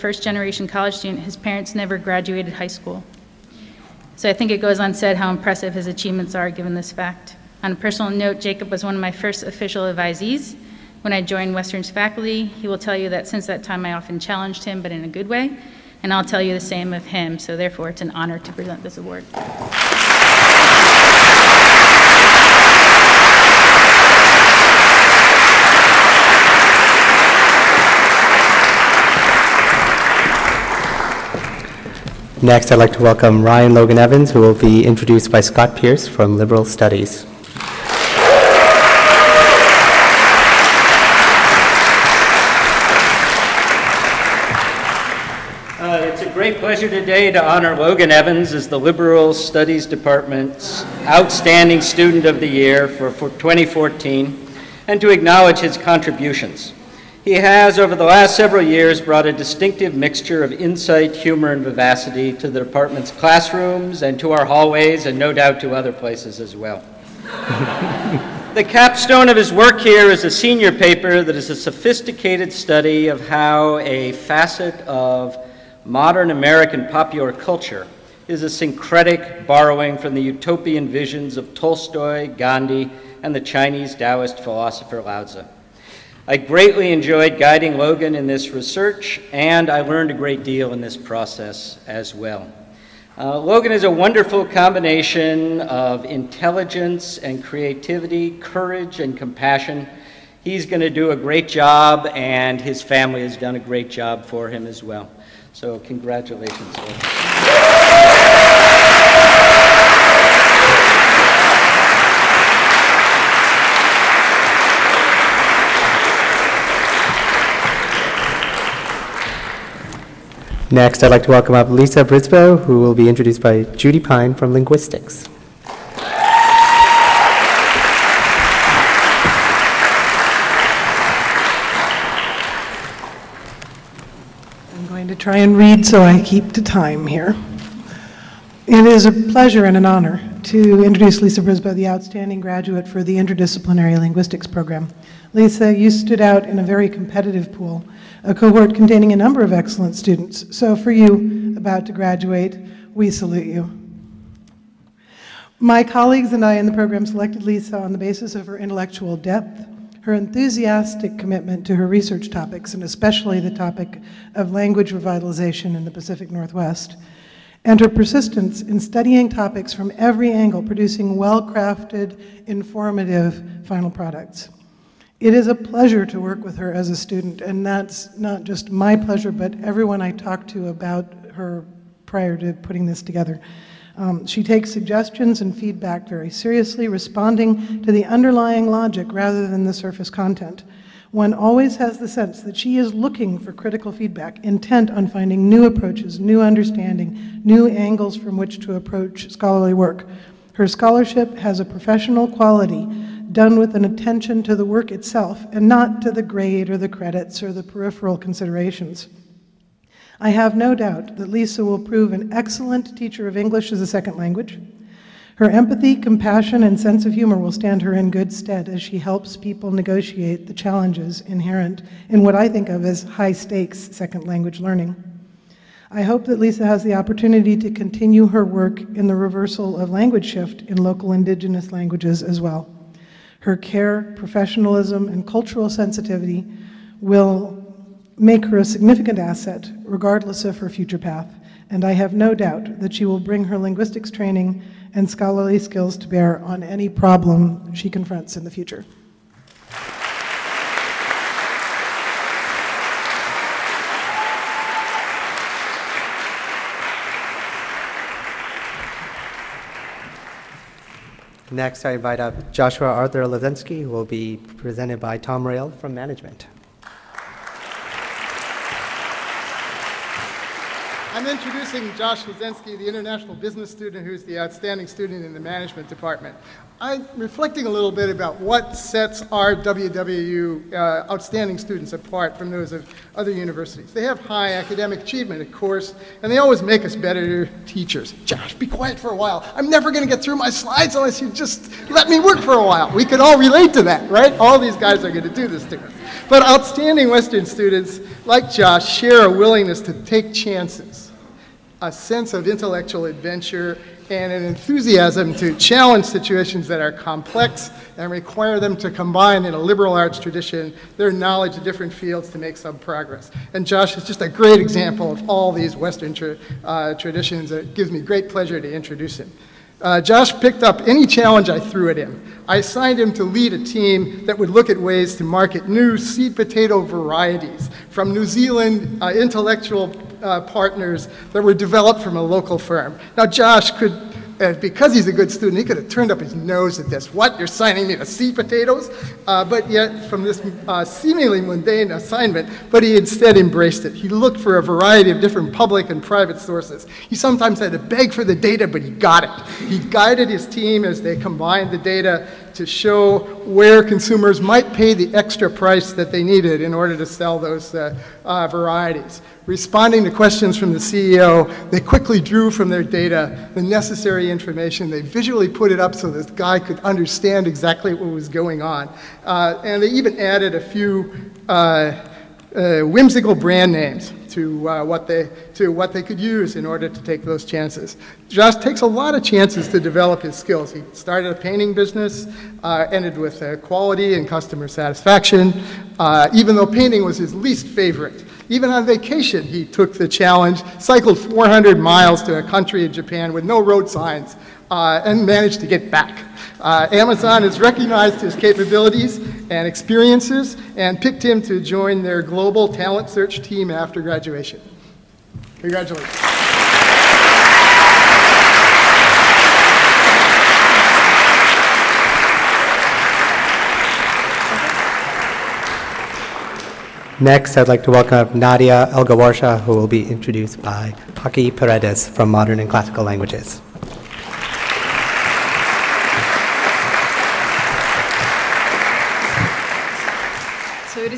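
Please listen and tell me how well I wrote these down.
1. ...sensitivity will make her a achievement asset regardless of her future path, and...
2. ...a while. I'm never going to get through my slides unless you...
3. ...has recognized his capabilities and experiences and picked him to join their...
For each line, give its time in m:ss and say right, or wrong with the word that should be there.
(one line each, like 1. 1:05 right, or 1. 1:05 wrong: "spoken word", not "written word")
1. 3:55 wrong: "significant", not "achievement"
2. 4:49 right
3. 6:37 right.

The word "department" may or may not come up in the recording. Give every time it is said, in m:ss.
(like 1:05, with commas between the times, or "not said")
0:49, 1:02, 4:35.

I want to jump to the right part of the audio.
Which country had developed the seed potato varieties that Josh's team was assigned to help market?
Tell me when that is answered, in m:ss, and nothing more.
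5:28.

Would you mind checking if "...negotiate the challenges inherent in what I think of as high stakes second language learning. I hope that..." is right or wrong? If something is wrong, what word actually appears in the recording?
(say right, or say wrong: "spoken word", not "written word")
right.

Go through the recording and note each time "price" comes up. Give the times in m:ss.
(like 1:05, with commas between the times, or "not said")
5:55.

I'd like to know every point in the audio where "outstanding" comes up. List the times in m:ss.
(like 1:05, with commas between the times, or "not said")
0:51, 2:21, 4:34, 4:41, 4:56.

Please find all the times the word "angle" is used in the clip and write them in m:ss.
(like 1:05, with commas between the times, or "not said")
2:50, 3:17.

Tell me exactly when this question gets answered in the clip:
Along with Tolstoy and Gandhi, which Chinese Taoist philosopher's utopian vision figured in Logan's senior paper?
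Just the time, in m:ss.
1:25.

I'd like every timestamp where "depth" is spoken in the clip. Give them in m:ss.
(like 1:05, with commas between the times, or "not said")
2:39.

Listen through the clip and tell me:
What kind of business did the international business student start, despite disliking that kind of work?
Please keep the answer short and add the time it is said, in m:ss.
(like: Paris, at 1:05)
painting business, at 6:21.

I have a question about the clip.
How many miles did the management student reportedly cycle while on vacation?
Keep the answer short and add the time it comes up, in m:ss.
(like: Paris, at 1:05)
400, at 6:31.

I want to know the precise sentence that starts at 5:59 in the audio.
Responding to questions from the CEO, they quickly drew from their data the necessary information.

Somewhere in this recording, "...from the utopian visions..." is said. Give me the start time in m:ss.
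1:19.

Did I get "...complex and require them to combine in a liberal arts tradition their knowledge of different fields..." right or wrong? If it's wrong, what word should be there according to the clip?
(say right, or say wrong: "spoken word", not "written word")
right.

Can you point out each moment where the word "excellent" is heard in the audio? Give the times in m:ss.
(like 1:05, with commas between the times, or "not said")
2:29, 3:32.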